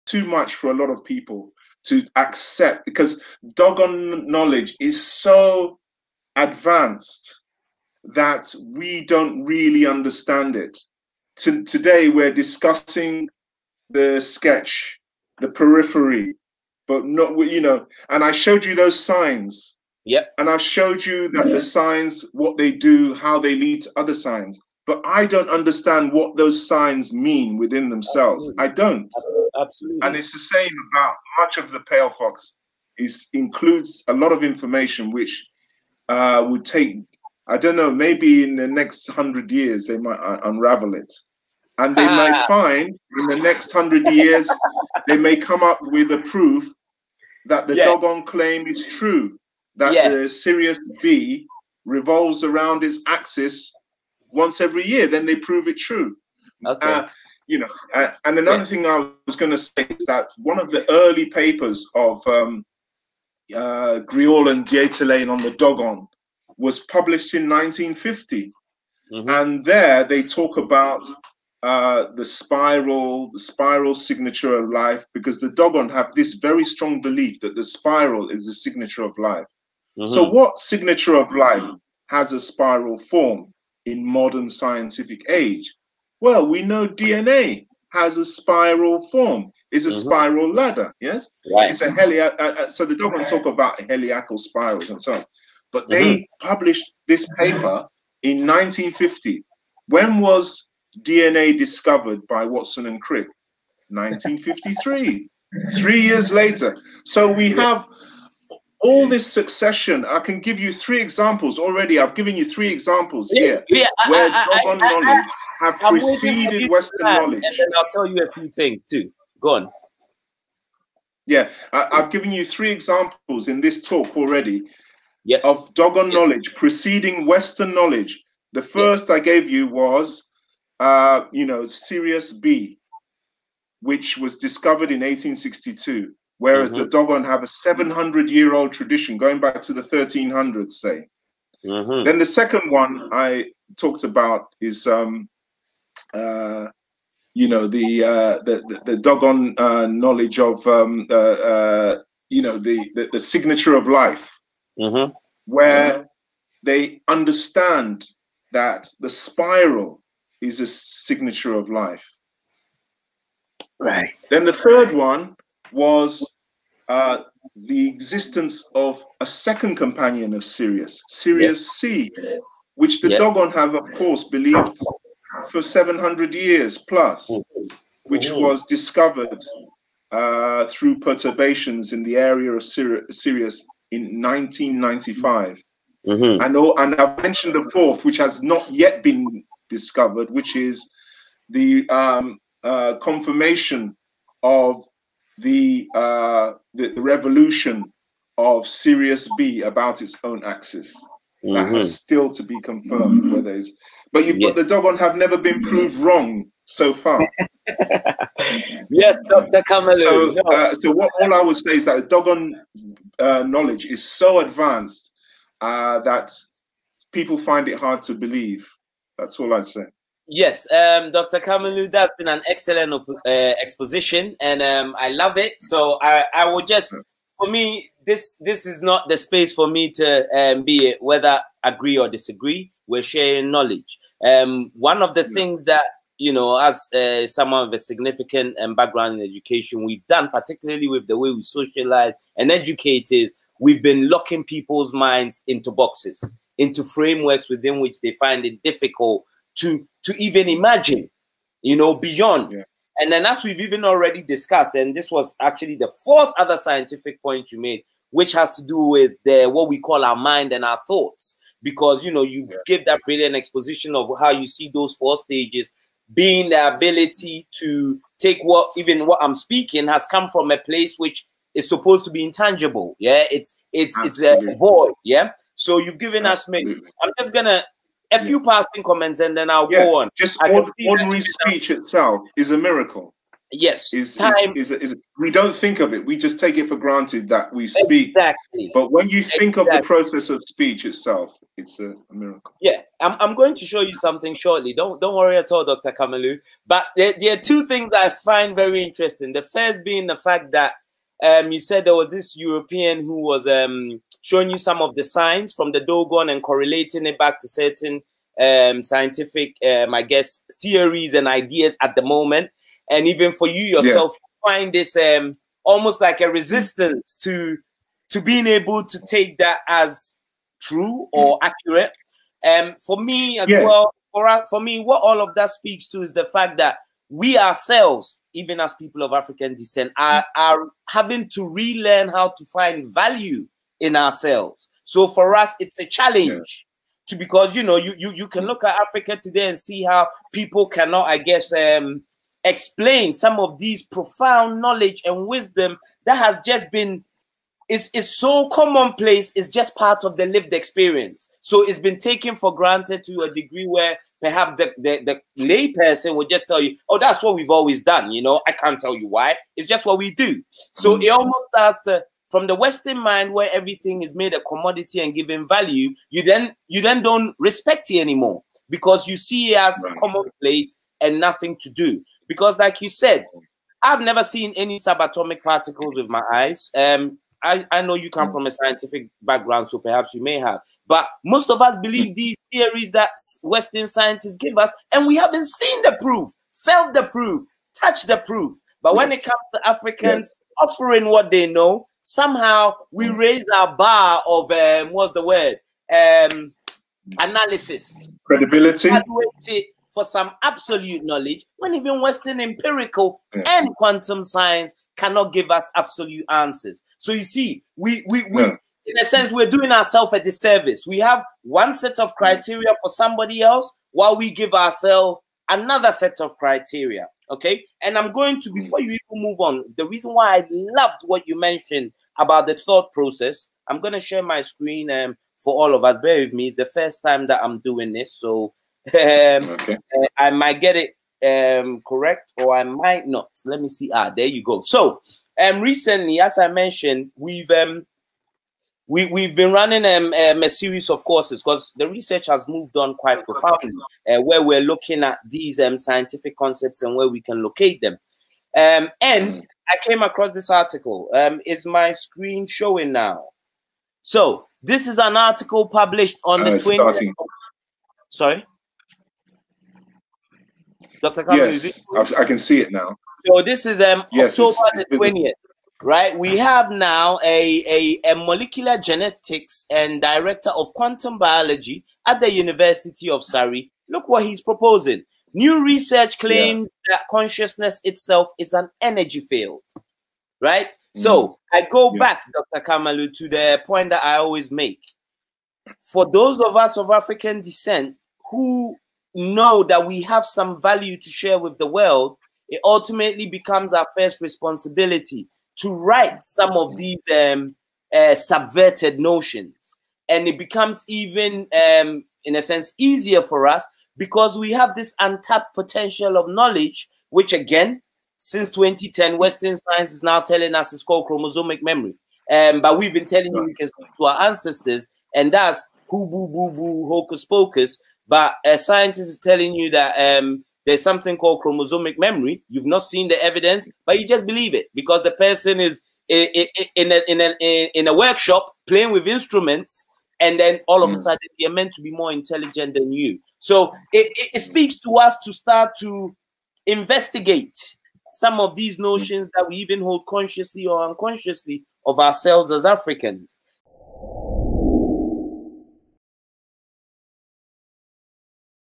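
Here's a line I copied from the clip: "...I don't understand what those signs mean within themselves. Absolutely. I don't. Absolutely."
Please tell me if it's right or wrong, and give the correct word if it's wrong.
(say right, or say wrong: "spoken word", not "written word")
right.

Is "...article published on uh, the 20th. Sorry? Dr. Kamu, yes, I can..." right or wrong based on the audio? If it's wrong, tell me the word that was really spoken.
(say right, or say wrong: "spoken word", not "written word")
right.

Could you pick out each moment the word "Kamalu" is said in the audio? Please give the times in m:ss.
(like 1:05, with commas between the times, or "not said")
3:29, 3:41, 4:55, 8:02.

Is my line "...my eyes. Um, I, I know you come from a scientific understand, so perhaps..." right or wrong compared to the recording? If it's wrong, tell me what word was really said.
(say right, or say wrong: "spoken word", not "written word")
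wrong: "background", not "understand".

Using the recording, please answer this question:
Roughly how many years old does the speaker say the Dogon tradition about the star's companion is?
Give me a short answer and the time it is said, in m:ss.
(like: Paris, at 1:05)
700, at 2:17.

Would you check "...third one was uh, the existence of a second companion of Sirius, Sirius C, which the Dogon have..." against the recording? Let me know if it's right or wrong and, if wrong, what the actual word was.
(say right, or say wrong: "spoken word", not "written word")
right.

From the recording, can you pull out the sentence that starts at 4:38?
passing comments and then I'll yeah.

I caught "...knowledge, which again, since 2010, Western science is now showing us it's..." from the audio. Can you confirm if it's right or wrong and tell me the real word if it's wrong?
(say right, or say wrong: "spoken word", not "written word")
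wrong: "telling", not "showing".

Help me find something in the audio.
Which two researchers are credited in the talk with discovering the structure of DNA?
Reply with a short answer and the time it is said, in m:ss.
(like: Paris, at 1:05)
Watson and Crick, at 1:42.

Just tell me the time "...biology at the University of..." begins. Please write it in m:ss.
7:51.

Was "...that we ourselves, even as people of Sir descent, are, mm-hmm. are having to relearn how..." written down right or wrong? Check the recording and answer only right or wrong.
wrong.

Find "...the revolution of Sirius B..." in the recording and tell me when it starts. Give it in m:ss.
3:16.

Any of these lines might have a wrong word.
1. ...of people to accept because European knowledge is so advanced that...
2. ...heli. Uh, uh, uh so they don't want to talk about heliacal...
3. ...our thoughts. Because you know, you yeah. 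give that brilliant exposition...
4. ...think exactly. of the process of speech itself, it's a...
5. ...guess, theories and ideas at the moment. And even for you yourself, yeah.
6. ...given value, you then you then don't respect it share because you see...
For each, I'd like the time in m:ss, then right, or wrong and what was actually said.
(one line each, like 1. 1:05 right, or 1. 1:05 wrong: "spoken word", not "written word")
1. 0:00 wrong: "Dogon", not "European"
2. 1:31 right
3. 4:20 right
4. 4:49 right
5. 5:10 right
6. 6:05 wrong: "anymore", not "share".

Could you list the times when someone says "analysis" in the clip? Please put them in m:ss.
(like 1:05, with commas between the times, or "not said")
6:37.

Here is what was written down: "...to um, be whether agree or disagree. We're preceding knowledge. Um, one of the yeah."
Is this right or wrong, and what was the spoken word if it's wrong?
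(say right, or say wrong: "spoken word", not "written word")
wrong: "sharing", not "preceding".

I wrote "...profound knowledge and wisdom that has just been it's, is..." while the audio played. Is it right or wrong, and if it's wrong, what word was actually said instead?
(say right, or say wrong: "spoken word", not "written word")
right.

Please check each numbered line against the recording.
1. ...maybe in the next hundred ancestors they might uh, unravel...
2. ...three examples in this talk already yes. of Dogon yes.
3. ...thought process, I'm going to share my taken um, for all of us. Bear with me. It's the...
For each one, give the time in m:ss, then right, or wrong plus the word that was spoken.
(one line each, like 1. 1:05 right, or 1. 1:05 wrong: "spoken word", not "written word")
1. 0:37 wrong: "years", not "ancestors"
2. 2:02 right
3. 7:02 wrong: "screen", not "taken".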